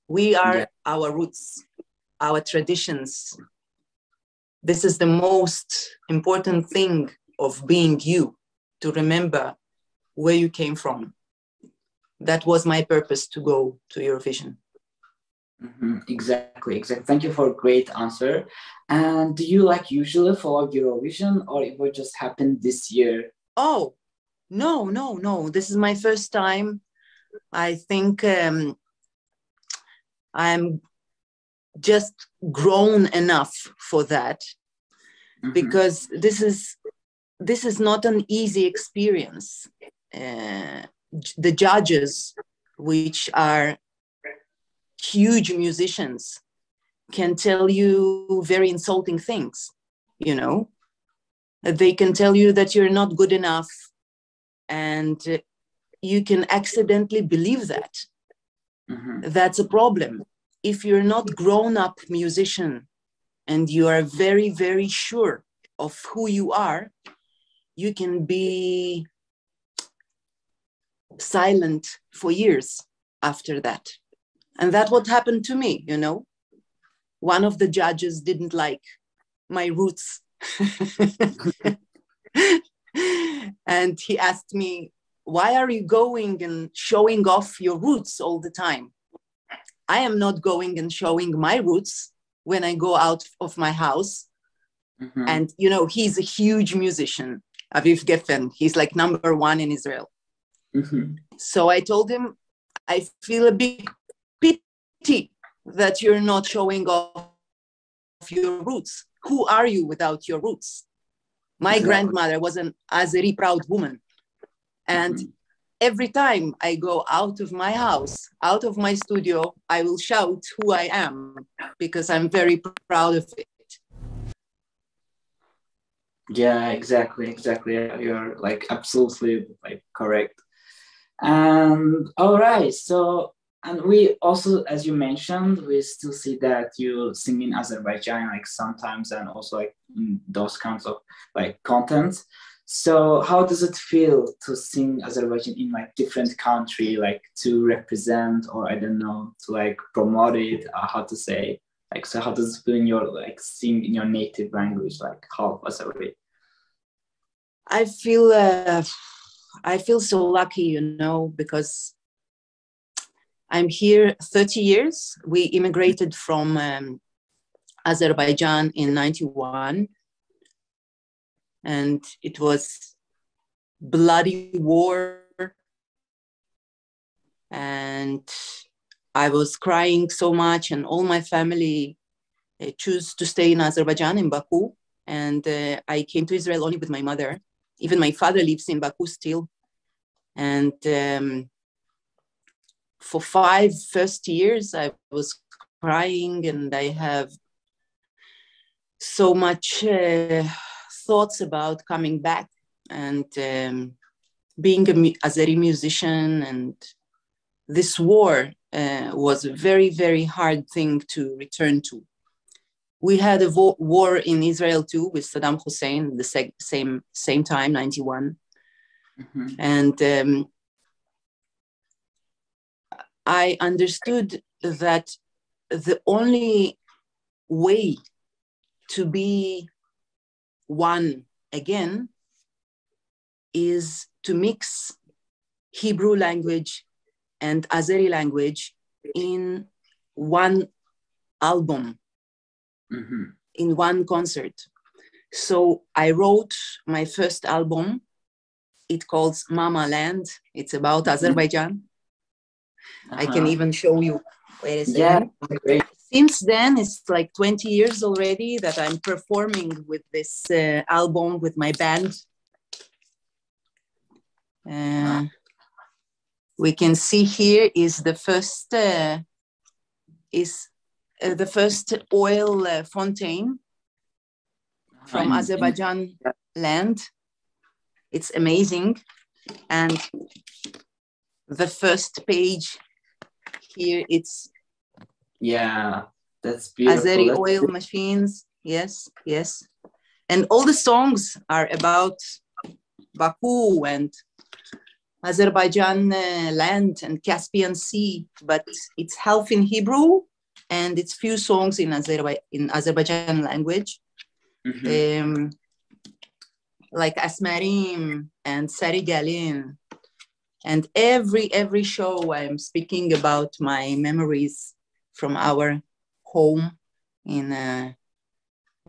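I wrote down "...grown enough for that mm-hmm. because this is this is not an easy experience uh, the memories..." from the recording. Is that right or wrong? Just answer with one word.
wrong.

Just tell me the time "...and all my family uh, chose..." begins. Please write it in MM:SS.
03:00.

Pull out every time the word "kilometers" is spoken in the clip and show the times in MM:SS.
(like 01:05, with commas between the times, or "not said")
not said.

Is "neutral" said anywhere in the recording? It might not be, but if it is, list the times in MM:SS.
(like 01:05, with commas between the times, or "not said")
not said.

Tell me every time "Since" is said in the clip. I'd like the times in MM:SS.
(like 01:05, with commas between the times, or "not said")
04:16.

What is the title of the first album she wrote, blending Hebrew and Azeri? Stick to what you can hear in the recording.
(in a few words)
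Mama Land.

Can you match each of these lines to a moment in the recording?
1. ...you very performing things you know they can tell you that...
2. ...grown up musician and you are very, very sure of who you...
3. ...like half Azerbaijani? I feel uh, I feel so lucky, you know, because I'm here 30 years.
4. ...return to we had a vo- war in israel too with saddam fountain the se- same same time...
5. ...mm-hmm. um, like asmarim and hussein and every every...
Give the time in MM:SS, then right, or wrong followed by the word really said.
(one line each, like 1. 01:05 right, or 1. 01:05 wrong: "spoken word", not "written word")
1. 00:47 wrong: "insulting", not "performing"
2. 01:01 right
3. 02:35 right
4. 03:31 wrong: "hussein", not "fountain"
5. 05:04 wrong: "sarigalin", not "hussein".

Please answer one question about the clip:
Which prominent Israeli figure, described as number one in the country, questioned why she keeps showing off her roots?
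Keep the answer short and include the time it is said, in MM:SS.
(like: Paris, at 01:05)
Aviv Geffen, at 01:37.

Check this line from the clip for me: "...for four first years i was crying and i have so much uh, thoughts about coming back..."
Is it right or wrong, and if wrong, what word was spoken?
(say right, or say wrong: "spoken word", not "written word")
wrong: "five", not "four".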